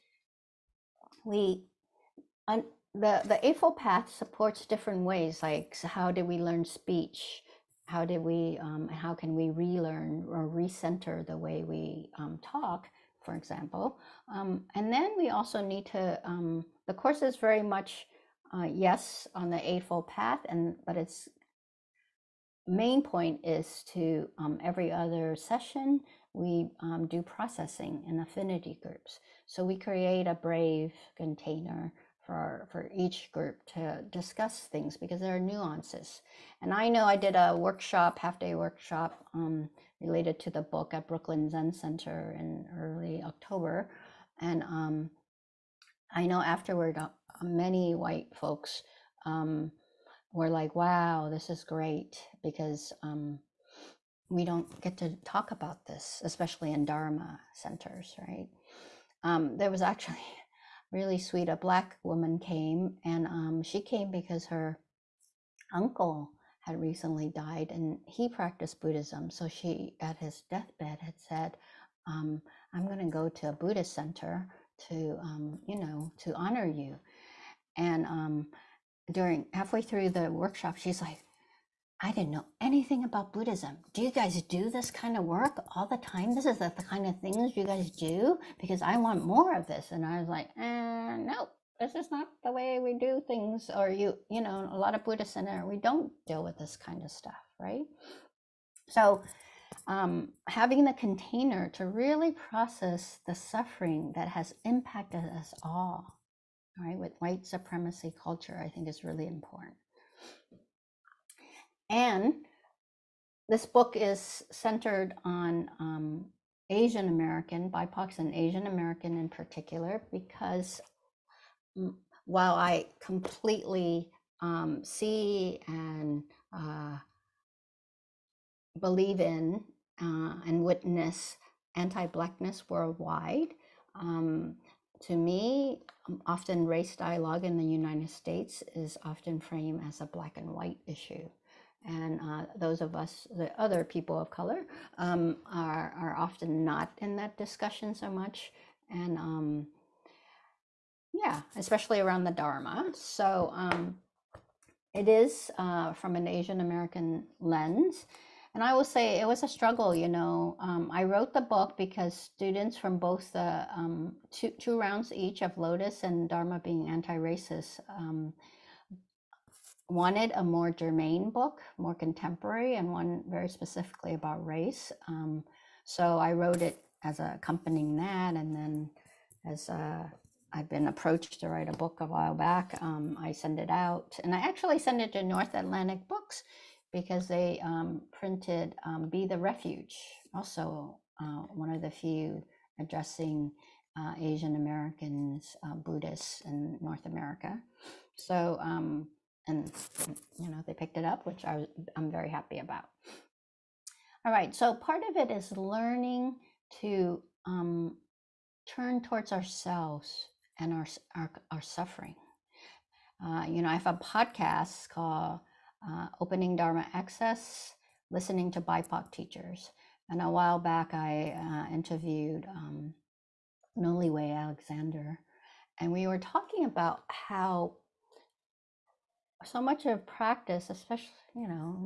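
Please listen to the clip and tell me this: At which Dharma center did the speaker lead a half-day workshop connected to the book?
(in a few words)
Brooklyn Zen Center.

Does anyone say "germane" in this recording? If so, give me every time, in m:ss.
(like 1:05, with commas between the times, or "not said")
2:50.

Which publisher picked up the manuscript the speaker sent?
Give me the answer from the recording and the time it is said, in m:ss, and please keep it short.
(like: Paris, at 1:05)
North Atlantic Books, at 3:05.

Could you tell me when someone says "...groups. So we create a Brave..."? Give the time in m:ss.
0:28.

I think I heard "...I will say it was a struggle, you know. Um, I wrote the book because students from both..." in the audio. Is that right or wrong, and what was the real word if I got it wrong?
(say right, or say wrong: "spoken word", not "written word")
right.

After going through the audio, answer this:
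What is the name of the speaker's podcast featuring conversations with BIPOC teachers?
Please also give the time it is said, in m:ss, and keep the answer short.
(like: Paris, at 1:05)
Opening Dharma Access, at 3:36.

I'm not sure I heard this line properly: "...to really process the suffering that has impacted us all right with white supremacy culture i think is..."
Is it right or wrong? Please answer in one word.
right.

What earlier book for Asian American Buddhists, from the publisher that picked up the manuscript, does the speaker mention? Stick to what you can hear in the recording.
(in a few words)
Be the Refuge.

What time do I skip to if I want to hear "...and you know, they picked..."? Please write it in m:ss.
3:19.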